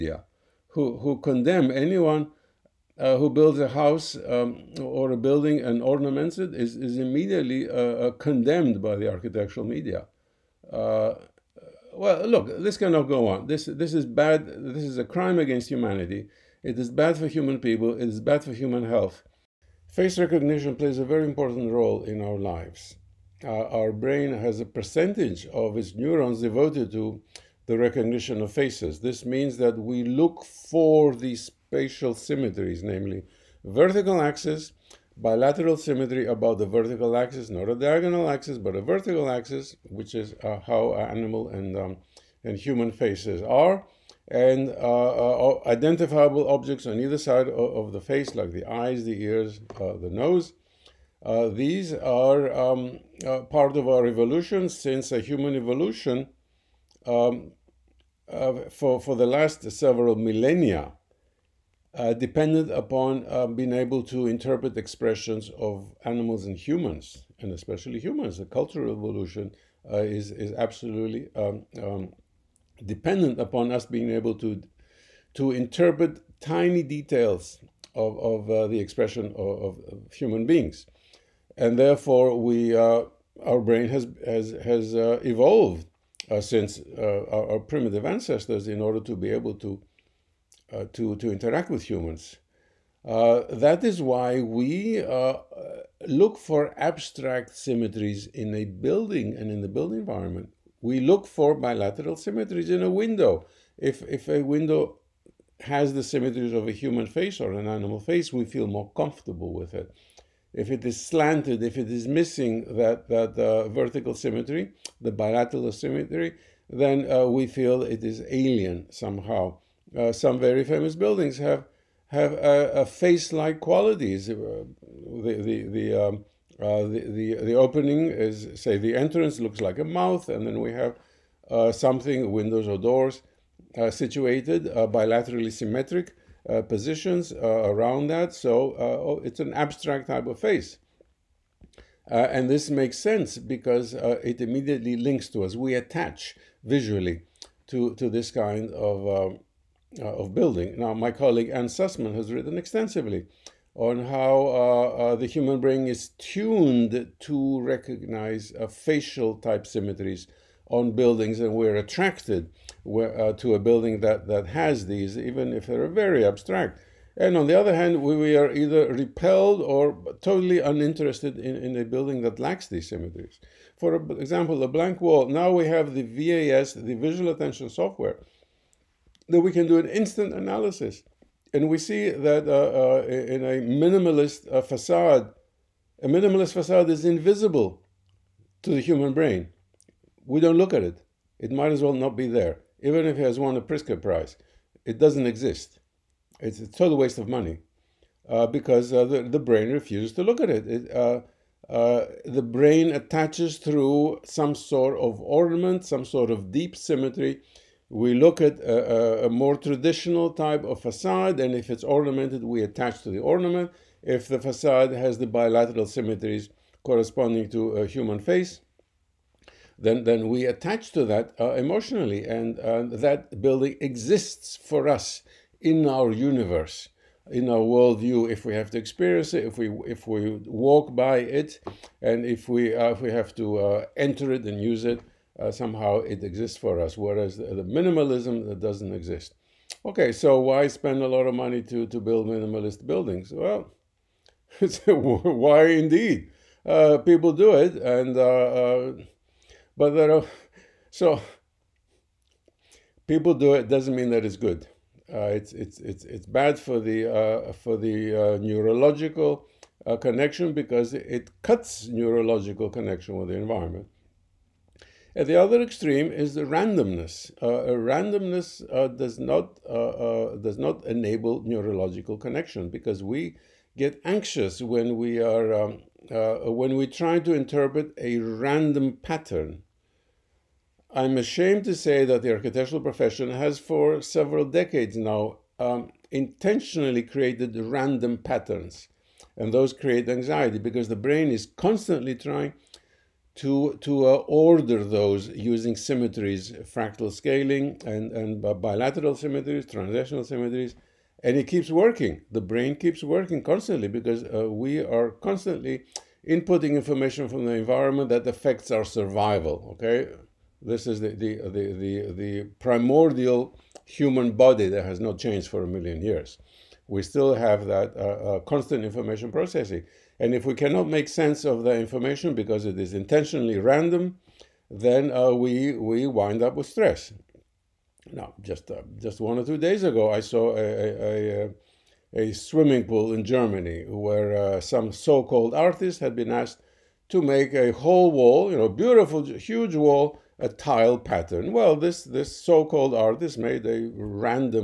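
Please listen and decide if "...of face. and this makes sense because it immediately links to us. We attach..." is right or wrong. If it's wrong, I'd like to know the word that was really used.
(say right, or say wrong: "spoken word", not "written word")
right.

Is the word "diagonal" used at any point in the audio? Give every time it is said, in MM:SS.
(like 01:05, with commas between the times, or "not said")
00:37.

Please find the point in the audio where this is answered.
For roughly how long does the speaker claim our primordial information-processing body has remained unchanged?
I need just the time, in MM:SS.
05:15.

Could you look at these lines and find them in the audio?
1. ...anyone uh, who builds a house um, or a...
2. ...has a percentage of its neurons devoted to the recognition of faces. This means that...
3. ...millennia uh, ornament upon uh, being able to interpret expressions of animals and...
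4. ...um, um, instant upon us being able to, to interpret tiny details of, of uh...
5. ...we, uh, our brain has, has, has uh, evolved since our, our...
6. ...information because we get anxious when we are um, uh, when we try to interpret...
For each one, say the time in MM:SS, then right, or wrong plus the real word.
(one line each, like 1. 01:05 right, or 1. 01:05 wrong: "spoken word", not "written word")
1. 00:01 right
2. 00:24 right
3. 01:00 wrong: "dependent", not "ornament"
4. 01:11 wrong: "dependent", not "instant"
5. 01:22 right
6. 04:32 wrong: "connection", not "information".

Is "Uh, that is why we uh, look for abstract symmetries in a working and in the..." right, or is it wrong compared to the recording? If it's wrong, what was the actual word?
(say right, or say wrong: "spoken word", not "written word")
wrong: "building", not "working".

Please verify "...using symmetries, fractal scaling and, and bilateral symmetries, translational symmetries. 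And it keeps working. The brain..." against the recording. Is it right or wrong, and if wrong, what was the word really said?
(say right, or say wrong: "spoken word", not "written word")
right.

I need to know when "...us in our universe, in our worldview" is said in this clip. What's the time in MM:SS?
03:44.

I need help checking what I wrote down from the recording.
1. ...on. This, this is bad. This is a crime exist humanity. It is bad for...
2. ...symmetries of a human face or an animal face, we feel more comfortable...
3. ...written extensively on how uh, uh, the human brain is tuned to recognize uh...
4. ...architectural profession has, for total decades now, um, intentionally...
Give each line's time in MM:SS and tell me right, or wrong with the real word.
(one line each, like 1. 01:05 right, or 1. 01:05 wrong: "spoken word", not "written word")
1. 00:13 wrong: "against", not "exist"
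2. 01:46 right
3. 02:32 right
4. 04:42 wrong: "several", not "total".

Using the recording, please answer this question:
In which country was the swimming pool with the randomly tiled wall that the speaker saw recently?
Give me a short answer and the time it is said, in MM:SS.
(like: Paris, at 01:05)
Germany, at 05:33.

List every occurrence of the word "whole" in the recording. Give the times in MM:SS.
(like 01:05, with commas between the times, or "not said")
05:37.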